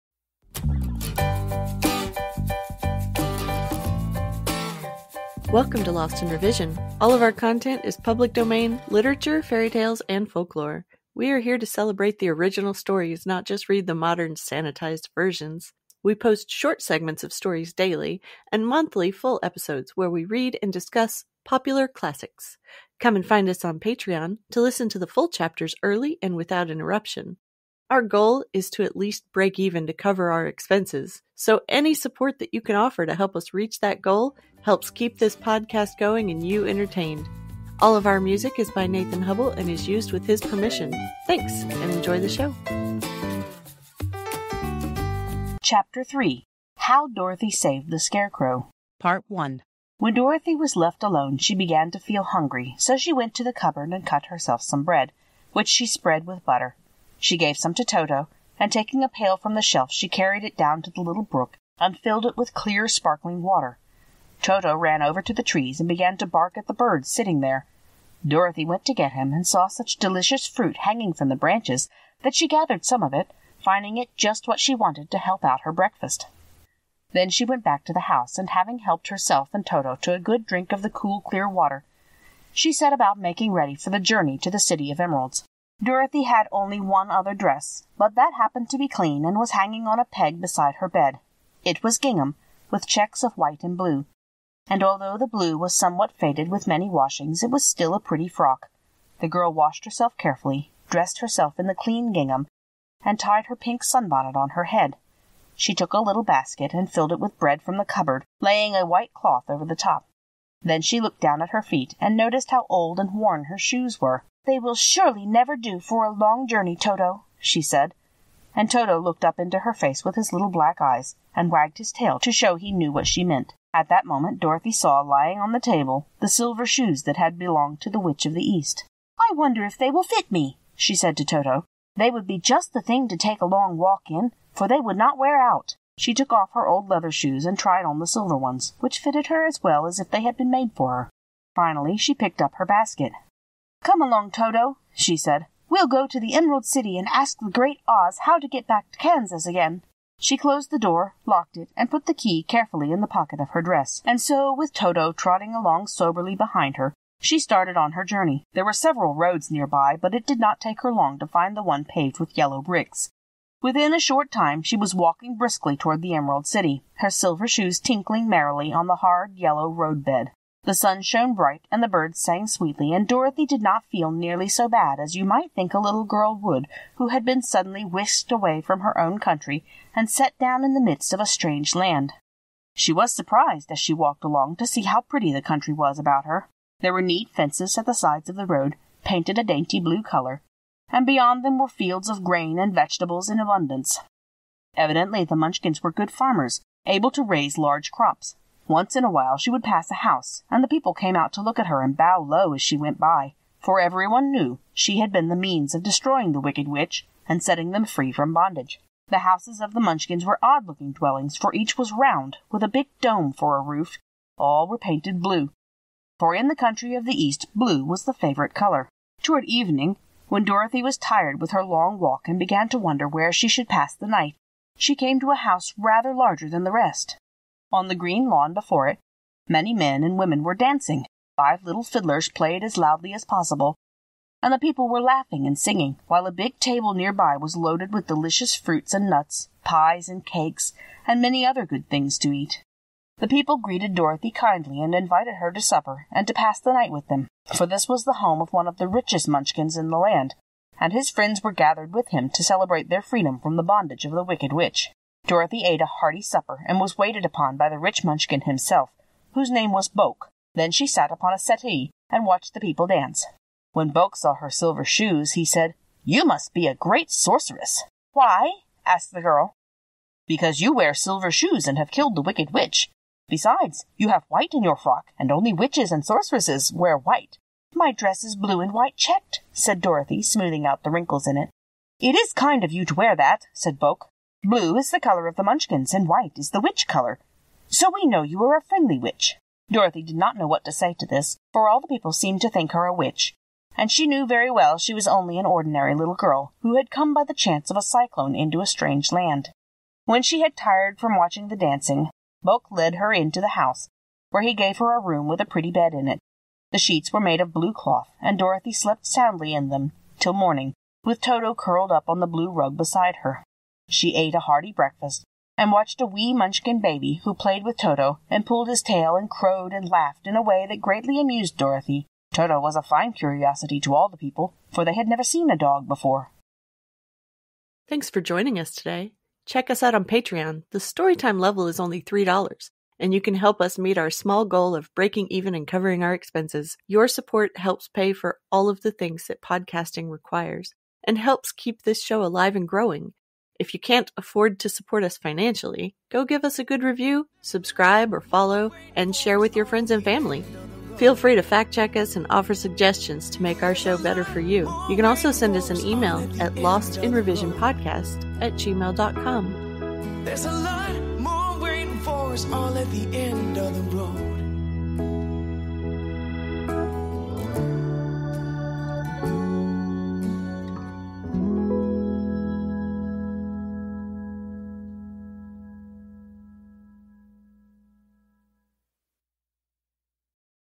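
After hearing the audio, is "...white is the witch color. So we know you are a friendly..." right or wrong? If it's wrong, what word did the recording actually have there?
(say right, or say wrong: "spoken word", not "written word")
right.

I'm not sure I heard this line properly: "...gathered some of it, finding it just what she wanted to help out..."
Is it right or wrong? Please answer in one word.
right.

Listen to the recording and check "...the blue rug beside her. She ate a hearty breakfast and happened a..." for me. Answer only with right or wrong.
wrong.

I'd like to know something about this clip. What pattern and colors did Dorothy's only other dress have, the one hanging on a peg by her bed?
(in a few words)
Checks of white and blue.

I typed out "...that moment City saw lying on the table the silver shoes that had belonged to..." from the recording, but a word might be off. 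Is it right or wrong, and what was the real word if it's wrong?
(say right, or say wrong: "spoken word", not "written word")
wrong: "Dorothy", not "City".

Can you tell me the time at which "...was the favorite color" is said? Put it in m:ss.
3:37.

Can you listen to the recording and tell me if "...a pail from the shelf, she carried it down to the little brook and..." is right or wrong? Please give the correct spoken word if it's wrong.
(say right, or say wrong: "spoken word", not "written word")
right.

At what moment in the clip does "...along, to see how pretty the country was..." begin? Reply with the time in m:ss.
3:04.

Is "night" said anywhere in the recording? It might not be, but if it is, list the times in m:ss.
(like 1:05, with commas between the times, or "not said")
3:44, 4:06.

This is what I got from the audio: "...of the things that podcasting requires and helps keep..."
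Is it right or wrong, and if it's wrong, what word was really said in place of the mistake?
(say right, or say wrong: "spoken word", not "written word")
right.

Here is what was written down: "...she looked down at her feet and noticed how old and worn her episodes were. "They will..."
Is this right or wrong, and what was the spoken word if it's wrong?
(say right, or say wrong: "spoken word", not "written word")
wrong: "shoes", not "episodes".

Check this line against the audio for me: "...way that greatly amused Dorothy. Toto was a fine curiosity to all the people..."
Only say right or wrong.
right.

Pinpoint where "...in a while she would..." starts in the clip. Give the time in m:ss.
3:18.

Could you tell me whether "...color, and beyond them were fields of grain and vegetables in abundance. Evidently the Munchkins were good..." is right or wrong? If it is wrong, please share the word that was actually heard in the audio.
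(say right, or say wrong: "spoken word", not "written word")
right.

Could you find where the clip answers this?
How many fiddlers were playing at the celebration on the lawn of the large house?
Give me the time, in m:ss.
3:51.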